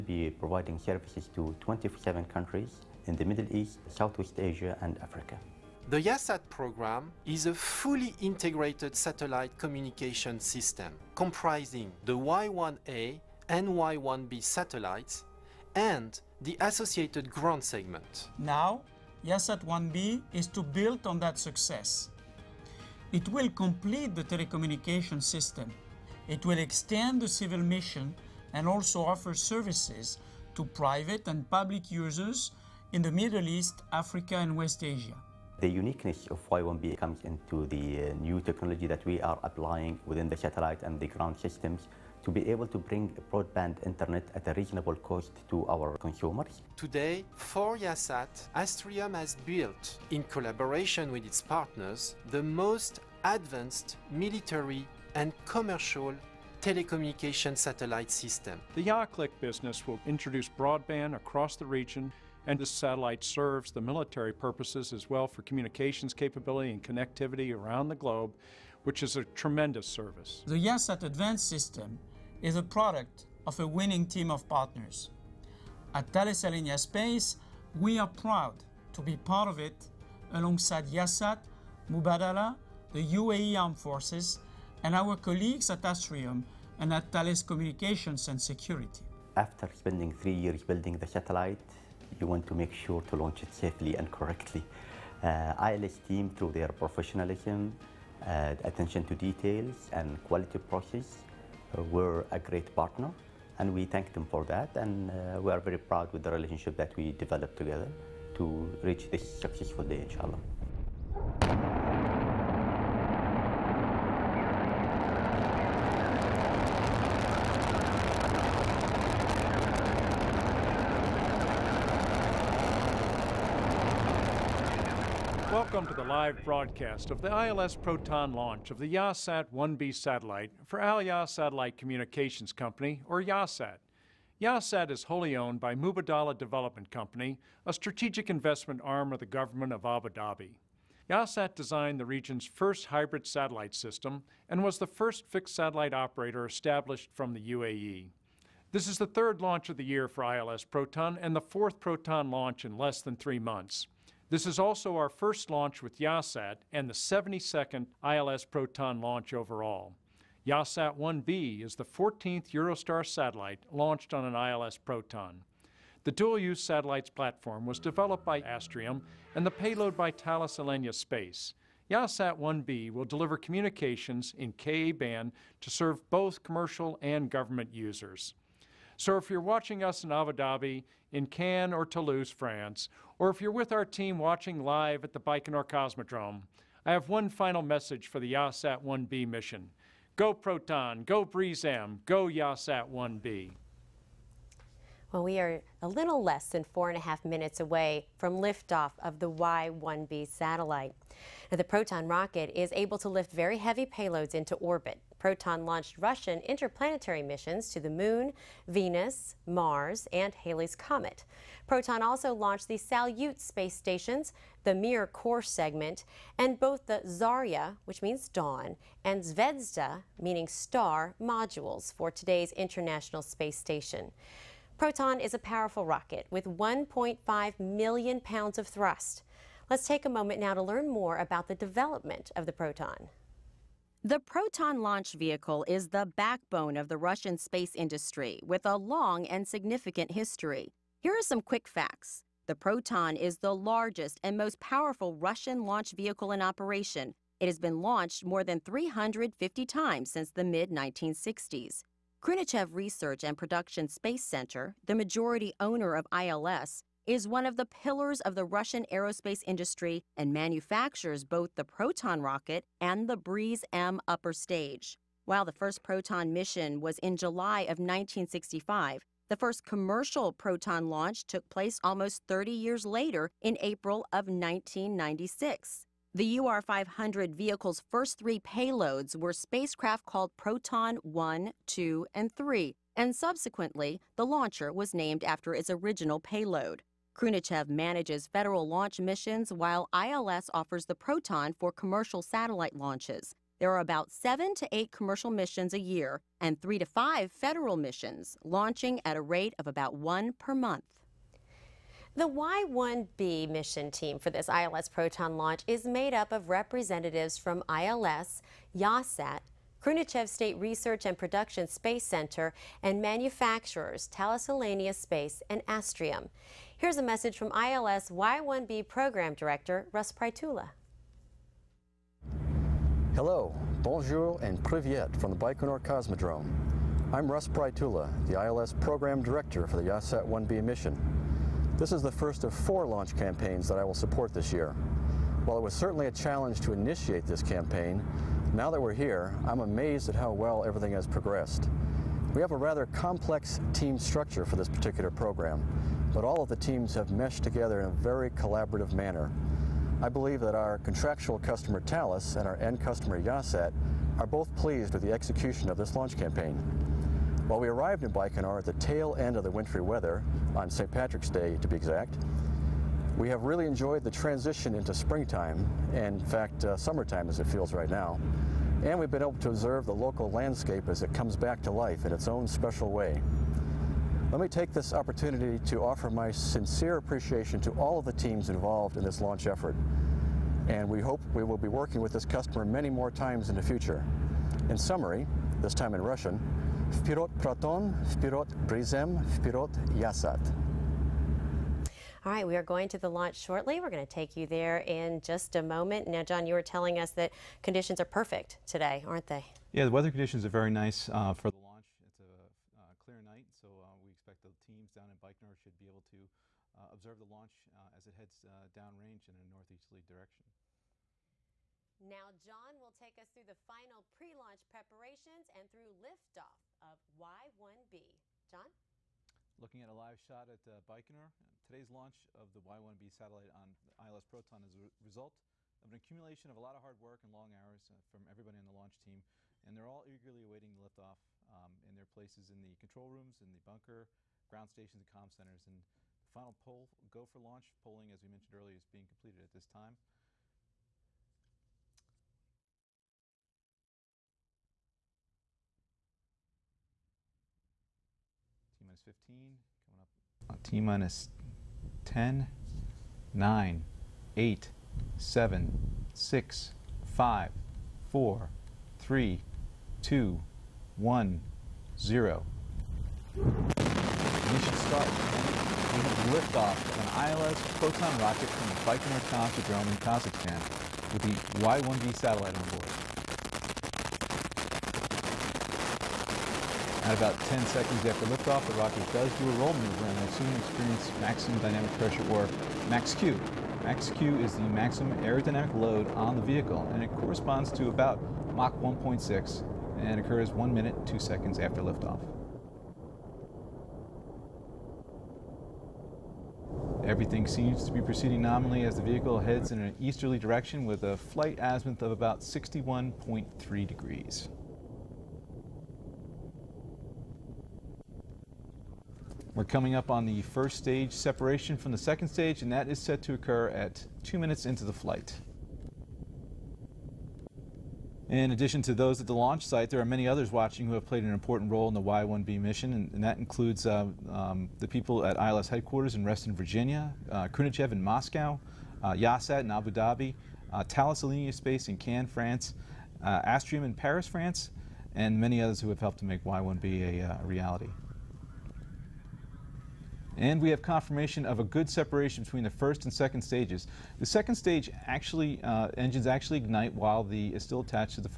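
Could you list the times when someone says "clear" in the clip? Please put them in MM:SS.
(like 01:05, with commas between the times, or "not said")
06:42.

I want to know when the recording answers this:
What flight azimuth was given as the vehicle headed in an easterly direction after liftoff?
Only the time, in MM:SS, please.
08:22.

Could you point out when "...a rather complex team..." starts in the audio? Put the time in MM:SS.
05:42.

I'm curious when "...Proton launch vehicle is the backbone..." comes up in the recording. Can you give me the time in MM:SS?
03:54.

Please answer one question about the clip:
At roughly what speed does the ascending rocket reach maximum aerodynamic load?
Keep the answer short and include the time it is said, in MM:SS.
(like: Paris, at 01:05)
Mach 1.6, at 08:08.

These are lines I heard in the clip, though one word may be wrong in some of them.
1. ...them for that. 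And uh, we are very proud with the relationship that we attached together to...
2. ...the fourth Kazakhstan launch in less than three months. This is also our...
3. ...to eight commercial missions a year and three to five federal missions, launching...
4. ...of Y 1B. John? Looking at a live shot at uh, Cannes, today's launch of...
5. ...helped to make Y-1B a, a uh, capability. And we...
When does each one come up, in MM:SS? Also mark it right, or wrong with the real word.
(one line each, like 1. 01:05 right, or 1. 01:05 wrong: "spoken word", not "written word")
1. 01:44 wrong: "developed", not "attached"
2. 02:31 wrong: "Proton", not "Kazakhstan"
3. 04:54 right
4. 06:56 wrong: "Baikonur", not "Cannes"
5. 08:55 wrong: "reality", not "capability".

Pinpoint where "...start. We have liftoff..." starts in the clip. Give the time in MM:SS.
07:43.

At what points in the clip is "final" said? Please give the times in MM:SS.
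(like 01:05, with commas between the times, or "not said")
03:07, 06:53, 07:16.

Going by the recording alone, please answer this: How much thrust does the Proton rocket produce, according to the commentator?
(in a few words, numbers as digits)
1.5 million pounds.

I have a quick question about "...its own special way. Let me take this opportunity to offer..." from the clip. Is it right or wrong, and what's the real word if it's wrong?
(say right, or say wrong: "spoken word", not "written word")
right.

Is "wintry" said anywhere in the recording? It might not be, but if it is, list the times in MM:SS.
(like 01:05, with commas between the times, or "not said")
05:59.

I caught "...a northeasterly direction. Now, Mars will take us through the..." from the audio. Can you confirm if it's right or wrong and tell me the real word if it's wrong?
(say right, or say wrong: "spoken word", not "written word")
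wrong: "John", not "Mars".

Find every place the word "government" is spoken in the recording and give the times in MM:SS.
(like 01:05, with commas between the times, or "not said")
02:19, 02:57.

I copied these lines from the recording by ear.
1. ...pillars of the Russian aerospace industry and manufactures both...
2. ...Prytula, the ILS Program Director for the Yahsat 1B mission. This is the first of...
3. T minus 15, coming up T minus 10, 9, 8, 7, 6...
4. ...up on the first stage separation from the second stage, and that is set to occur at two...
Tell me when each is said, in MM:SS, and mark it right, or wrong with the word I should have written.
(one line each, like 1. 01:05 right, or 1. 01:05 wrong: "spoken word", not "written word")
1. 04:17 right
2. 05:27 right
3. 07:28 right
4. 08:29 right.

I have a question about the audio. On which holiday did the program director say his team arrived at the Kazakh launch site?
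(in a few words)
St. Patrick's Day.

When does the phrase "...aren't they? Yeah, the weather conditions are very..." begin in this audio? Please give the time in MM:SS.
06:39.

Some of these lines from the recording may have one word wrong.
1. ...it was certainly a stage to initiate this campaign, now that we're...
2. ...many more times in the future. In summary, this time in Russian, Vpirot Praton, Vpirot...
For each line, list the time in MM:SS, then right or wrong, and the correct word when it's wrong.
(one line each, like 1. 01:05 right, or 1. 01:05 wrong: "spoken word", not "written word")
1. 05:35 wrong: "challenge", not "stage"
2. 06:22 right.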